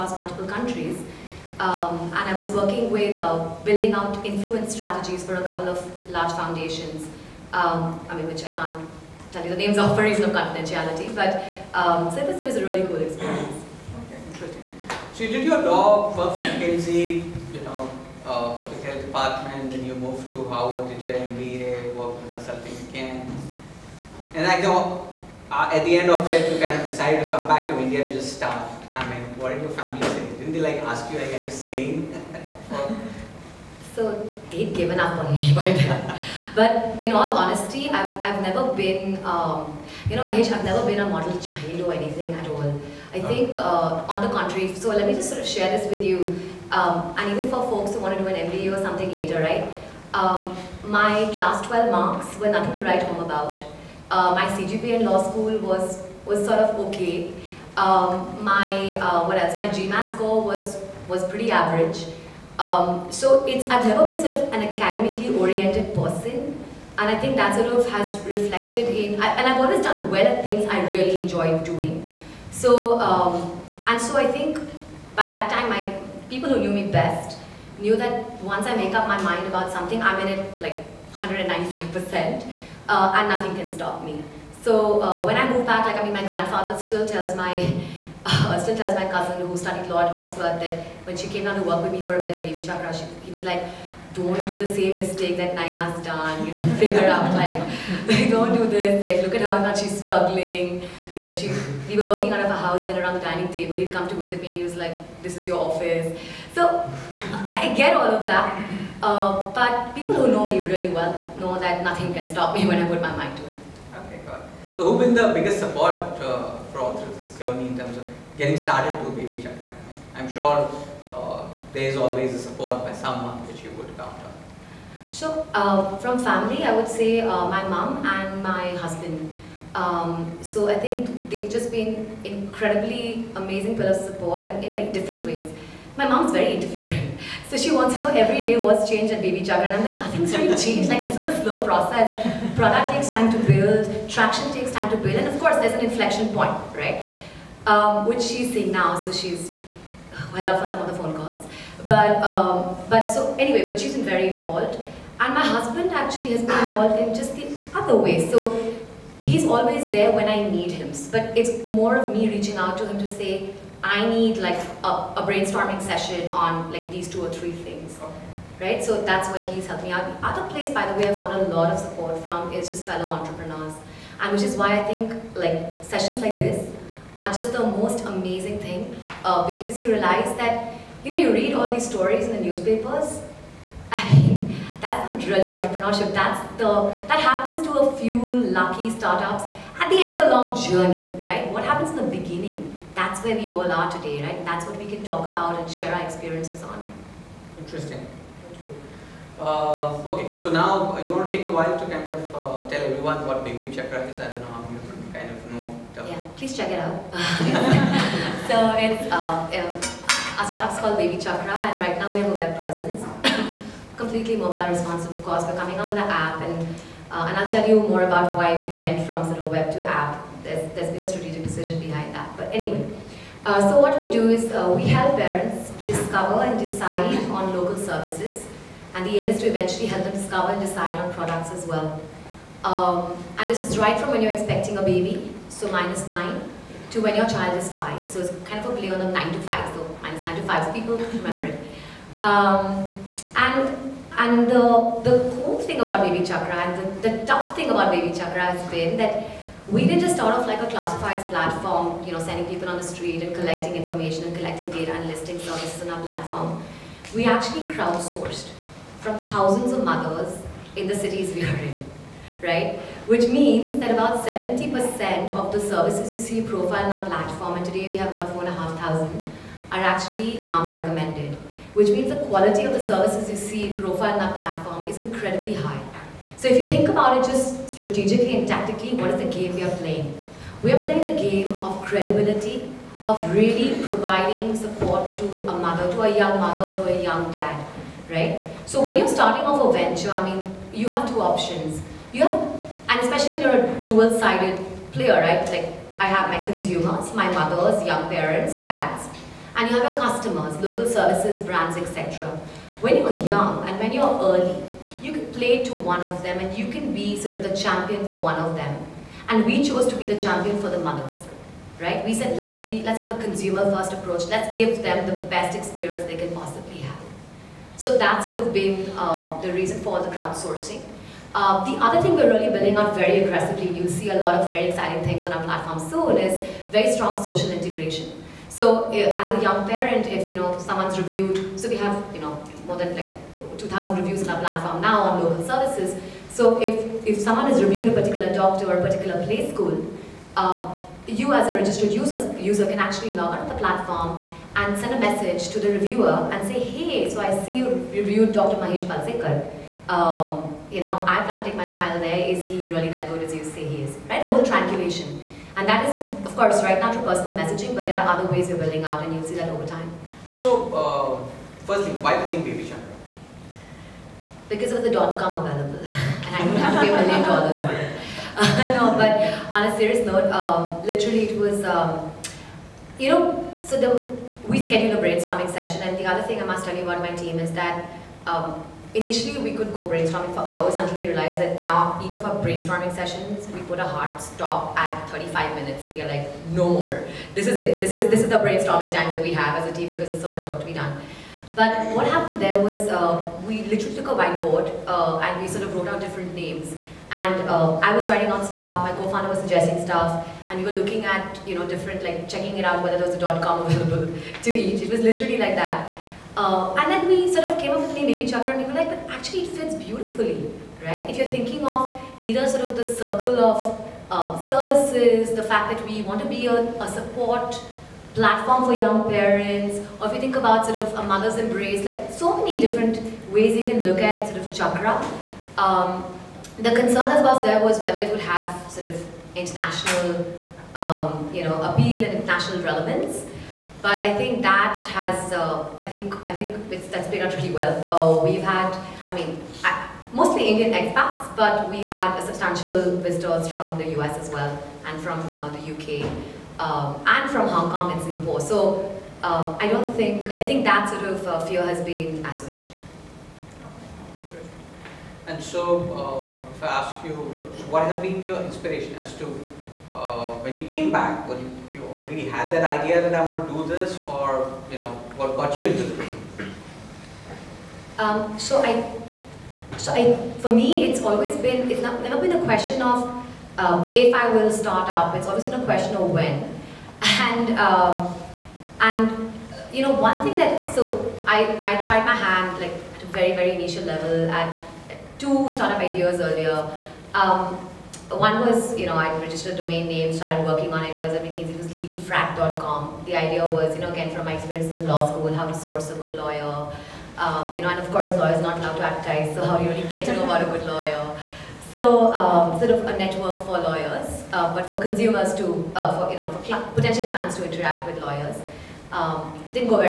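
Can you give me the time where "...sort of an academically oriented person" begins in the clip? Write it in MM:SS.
01:04.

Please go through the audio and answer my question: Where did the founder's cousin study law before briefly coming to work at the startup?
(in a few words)
Oxford.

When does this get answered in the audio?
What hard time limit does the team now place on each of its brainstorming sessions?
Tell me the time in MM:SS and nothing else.
06:25.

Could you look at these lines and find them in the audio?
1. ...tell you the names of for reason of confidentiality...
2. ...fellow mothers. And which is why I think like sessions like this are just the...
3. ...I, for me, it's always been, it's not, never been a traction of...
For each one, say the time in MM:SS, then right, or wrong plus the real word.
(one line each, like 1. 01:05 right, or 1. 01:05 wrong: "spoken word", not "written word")
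1. 00:09 right
2. 02:52 wrong: "entrepreneurs", not "mothers"
3. 07:49 wrong: "question", not "traction".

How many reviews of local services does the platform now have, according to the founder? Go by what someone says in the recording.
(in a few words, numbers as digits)
2,000.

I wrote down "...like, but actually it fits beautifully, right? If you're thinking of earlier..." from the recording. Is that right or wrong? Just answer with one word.
wrong.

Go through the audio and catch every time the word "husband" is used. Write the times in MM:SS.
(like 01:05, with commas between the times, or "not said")
02:08, 02:35.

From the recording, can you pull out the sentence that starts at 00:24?
And I know uh, at the end of it, you kind of decided to come back to India to just start.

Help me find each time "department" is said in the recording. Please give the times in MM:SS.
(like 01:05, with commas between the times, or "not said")
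00:19.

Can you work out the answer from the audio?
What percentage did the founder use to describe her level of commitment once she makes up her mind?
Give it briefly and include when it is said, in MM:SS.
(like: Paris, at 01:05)
195%, at 01:21.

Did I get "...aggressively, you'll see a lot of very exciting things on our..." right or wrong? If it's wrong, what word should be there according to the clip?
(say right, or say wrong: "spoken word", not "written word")
right.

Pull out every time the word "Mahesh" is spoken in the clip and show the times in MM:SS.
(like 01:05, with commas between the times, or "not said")
00:40, 05:48.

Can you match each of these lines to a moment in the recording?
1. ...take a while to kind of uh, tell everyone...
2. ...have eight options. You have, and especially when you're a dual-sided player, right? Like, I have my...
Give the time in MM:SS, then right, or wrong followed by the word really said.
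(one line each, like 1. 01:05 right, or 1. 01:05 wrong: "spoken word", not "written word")
1. 03:21 right
2. 04:50 wrong: "two", not "eight".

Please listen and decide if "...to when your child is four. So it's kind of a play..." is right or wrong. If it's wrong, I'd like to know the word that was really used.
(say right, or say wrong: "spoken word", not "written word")
wrong: "five", not "four".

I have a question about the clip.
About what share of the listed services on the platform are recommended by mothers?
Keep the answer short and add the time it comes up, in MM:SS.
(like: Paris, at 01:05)
70%, at 04:24.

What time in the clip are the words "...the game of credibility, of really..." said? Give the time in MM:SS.
04:41.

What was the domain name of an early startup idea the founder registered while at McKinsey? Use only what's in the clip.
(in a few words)
legalfrack.com.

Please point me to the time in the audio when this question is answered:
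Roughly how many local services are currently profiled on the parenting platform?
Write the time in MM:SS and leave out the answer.
04:28.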